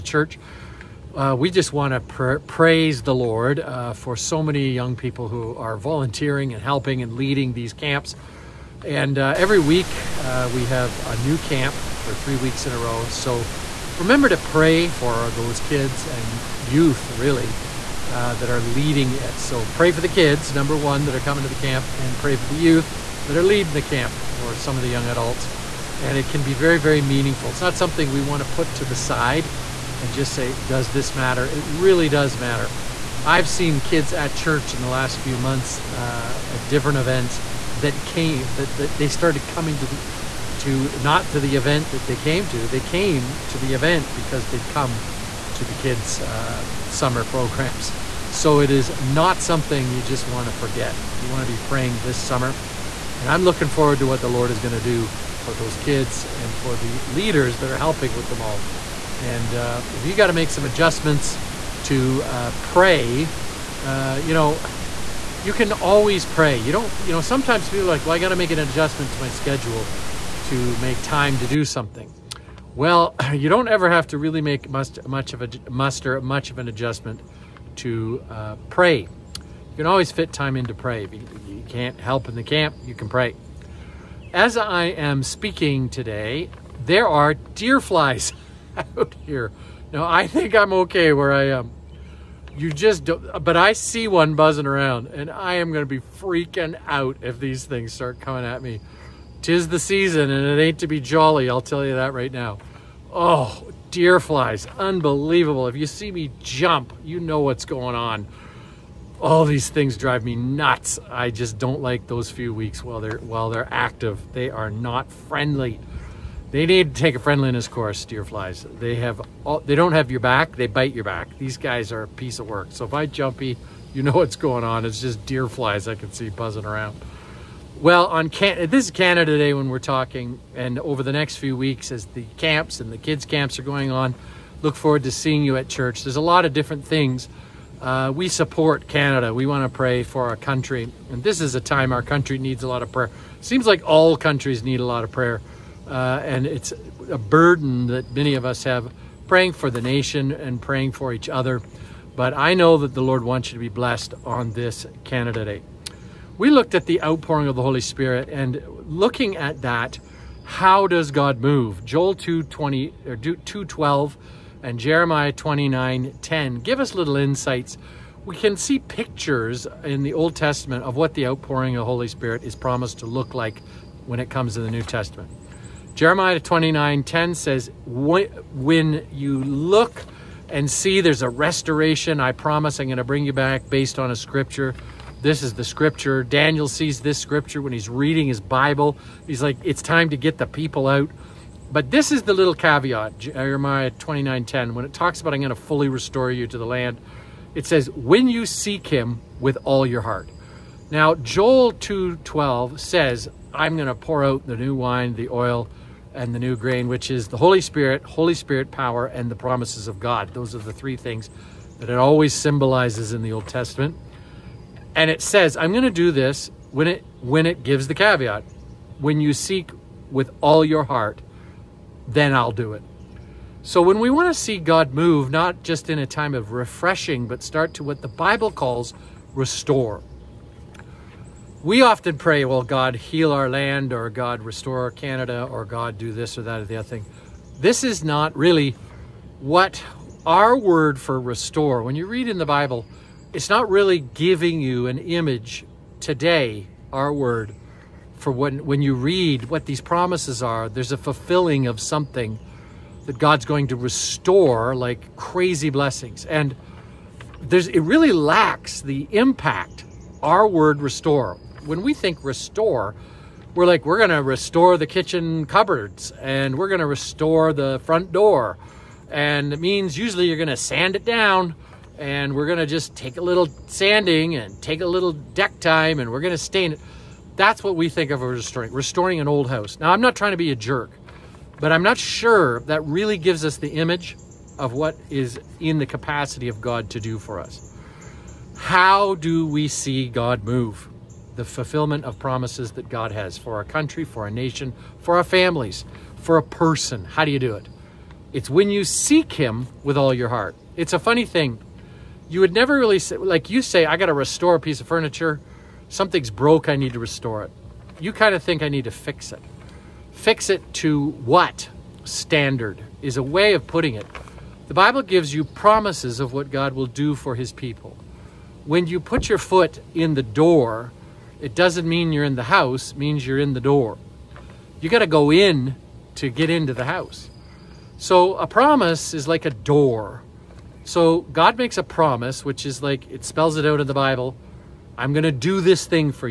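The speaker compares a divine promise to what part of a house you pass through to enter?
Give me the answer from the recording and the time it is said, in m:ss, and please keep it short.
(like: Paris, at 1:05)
A door, at 5:29.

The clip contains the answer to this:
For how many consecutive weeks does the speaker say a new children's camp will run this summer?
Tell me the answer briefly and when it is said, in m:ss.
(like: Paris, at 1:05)
3, at 0:12.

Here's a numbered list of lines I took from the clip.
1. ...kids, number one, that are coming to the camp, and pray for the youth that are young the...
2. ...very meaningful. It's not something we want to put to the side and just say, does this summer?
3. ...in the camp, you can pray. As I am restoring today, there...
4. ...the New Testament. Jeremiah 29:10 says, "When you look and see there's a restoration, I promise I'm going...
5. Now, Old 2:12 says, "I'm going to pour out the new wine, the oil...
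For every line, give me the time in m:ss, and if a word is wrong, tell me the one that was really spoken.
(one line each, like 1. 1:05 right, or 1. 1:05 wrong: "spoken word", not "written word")
1. 0:20 wrong: "leading", not "young"
2. 0:26 wrong: "matter", not "summer"
3. 1:22 wrong: "speaking", not "restoring"
4. 2:54 right
5. 3:20 wrong: "Joel", not "Old".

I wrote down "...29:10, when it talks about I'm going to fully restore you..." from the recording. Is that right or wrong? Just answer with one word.
right.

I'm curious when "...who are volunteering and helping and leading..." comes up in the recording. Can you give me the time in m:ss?
0:05.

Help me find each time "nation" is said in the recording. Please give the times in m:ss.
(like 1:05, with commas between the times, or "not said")
2:29, 4:54.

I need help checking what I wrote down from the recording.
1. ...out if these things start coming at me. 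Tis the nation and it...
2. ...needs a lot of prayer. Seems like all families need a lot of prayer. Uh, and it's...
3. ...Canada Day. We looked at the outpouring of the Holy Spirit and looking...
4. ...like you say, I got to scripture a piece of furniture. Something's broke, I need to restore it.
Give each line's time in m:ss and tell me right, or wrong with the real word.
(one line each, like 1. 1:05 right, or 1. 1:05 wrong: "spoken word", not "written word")
1. 1:36 wrong: "season", not "nation"
2. 2:22 wrong: "countries", not "families"
3. 2:35 right
4. 5:03 wrong: "restore", not "scripture".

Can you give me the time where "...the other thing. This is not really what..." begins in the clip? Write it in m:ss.
3:56.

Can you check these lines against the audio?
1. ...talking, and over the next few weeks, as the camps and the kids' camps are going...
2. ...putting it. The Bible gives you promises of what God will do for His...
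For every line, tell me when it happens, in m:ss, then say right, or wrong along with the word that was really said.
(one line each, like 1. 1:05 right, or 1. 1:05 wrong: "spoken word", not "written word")
1. 2:09 right
2. 5:13 right.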